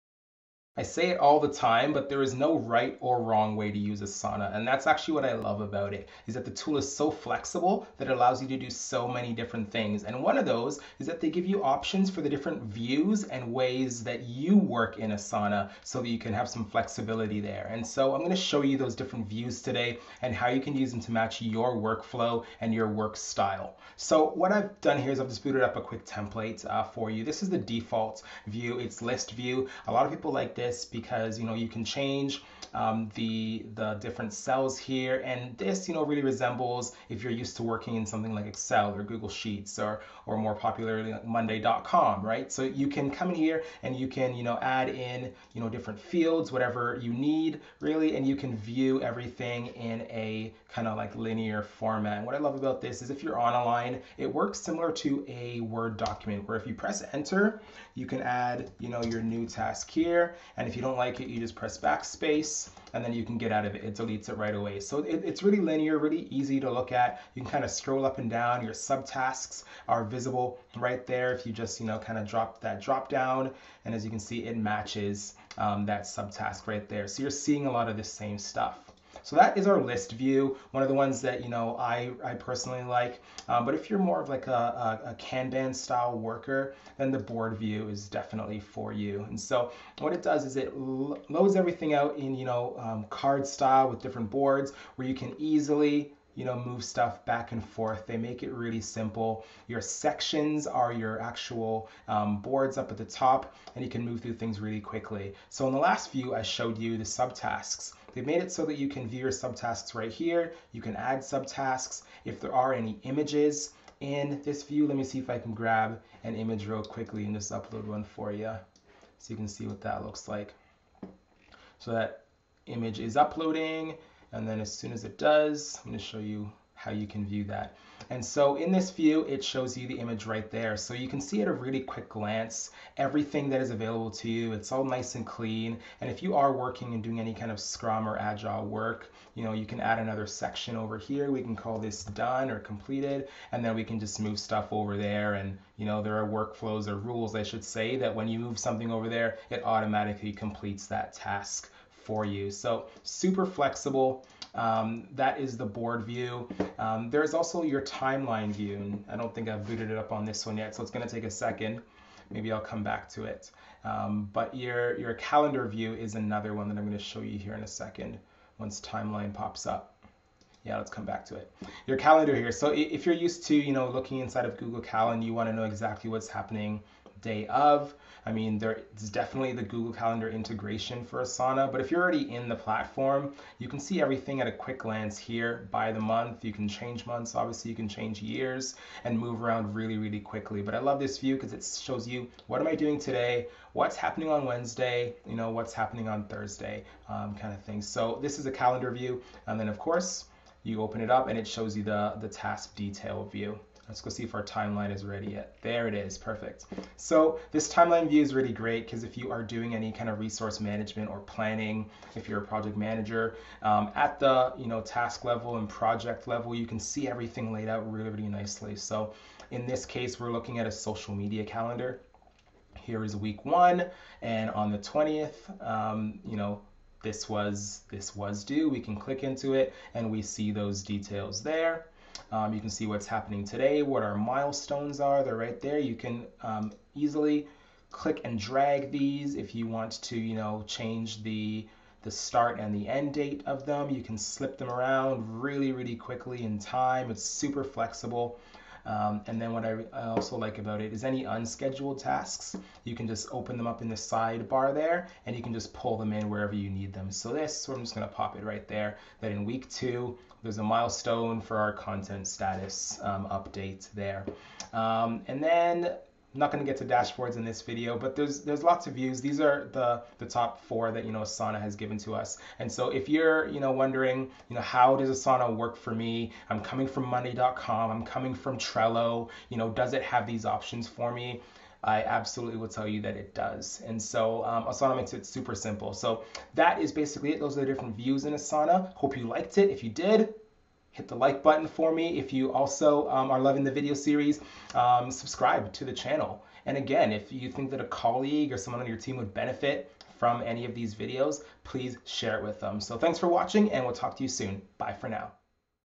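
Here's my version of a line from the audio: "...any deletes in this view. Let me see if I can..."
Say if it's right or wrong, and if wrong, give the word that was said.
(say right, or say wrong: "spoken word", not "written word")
wrong: "images", not "deletes".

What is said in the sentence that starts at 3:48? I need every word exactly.
We can click into it and we see those details there.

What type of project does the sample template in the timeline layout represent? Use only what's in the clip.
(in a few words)
social media calendar.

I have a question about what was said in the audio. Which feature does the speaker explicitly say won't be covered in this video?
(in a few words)
dashboards.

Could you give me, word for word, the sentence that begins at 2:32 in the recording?
So super flexible um, that is the board view.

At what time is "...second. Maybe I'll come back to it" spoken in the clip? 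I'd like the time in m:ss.
2:41.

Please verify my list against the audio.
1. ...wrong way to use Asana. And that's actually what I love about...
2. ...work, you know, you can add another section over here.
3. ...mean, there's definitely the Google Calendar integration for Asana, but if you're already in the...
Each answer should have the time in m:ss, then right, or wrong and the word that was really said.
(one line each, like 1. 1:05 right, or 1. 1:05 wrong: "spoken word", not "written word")
1. 0:03 right
2. 2:18 right
3. 2:58 right.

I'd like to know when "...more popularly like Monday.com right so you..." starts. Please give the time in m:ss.
0:40.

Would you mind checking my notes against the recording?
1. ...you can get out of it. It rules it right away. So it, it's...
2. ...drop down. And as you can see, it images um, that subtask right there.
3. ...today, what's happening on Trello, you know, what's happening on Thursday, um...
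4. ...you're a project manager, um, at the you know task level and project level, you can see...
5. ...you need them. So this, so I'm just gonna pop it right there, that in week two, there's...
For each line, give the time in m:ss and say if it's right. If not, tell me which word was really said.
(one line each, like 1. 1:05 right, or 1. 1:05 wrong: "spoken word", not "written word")
1. 1:03 wrong: "deletes", not "rules"
2. 1:12 wrong: "matches", not "images"
3. 3:12 wrong: "Wednesday", not "Trello"
4. 3:32 right
5. 4:16 right.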